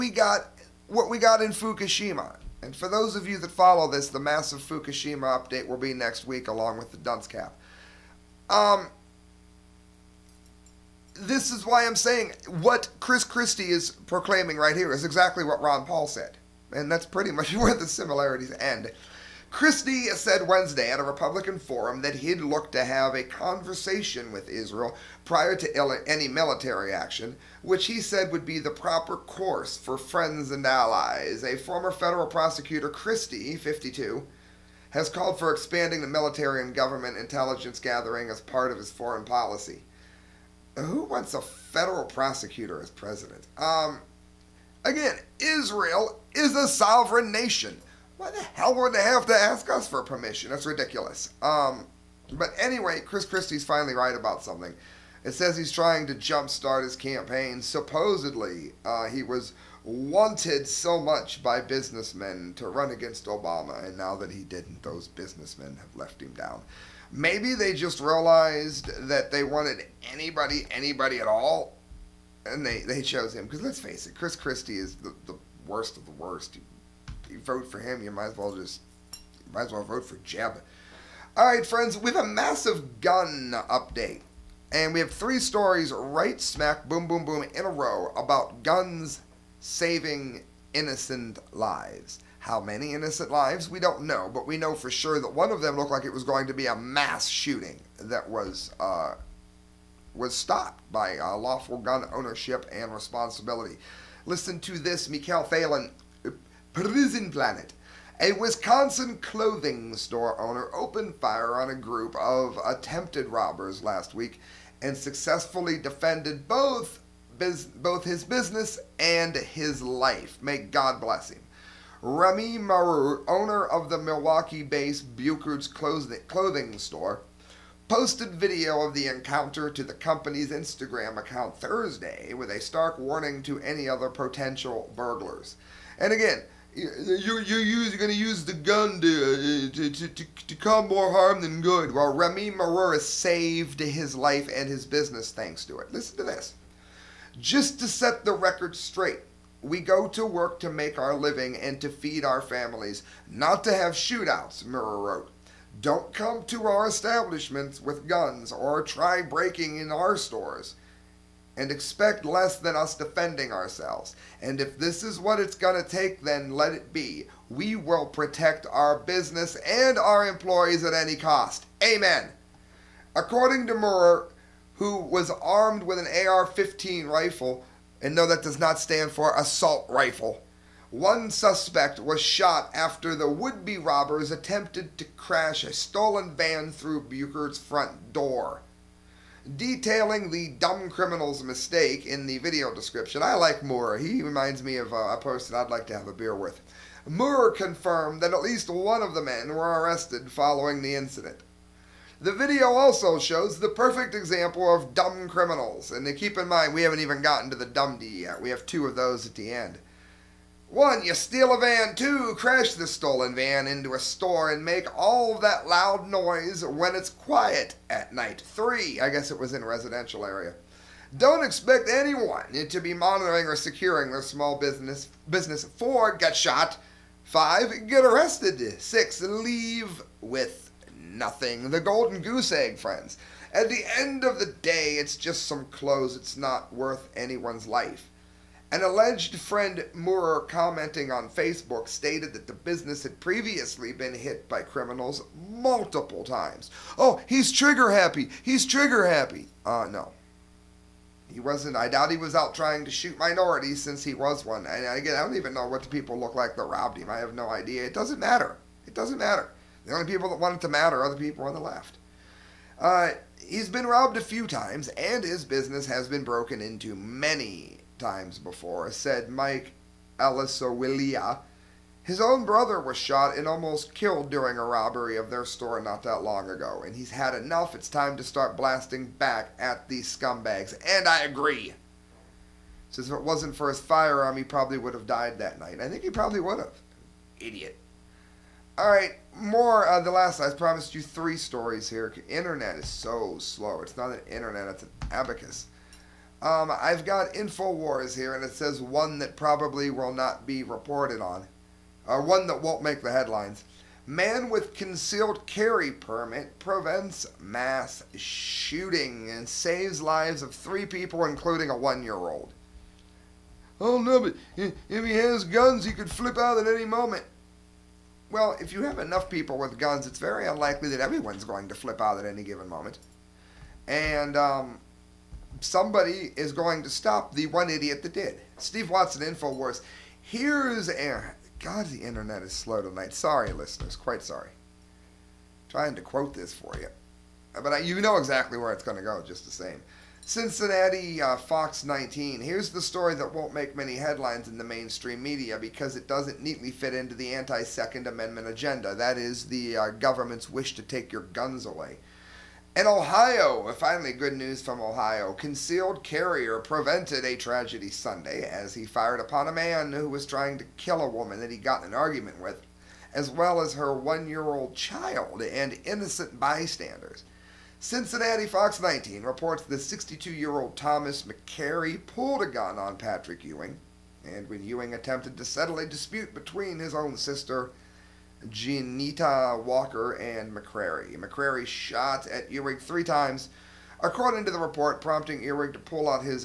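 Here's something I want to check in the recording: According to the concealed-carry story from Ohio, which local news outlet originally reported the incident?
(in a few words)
Cincinnati Fox 19.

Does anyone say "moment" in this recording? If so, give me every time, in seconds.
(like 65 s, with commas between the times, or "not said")
316 s, 322 s.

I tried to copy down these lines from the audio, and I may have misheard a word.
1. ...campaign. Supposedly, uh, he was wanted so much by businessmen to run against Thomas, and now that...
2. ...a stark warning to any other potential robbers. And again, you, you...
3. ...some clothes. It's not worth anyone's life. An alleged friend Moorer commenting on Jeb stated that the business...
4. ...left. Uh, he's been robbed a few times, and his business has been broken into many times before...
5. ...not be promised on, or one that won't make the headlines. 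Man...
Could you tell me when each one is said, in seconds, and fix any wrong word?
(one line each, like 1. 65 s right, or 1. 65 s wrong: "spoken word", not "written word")
1. 56 s wrong: "Obama", not "Thomas"
2. 132 s wrong: "burglars", not "robbers"
3. 235 s wrong: "Facebook", not "Jeb"
4. 261 s right
5. 300 s wrong: "reported", not "promised".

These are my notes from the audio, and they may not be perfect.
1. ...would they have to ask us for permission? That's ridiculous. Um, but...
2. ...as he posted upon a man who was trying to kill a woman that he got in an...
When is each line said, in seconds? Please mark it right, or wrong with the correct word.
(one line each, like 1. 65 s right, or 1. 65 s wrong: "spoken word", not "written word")
1. 48 s right
2. 358 s wrong: "fired", not "posted".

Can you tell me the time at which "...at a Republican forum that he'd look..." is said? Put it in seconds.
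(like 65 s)
20 s.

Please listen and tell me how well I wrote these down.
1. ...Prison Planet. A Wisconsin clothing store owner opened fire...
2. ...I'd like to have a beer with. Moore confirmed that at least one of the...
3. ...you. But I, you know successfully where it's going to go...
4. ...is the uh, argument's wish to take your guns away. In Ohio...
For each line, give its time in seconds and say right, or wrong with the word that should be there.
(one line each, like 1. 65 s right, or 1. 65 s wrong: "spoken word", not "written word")
1. 106 s right
2. 195 s right
3. 336 s wrong: "exactly", not "successfully"
4. 349 s wrong: "government", not "argument".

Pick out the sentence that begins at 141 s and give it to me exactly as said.
Well, Remy Maru saved his life and his business thanks to it.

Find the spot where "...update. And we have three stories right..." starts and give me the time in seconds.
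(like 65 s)
83 s.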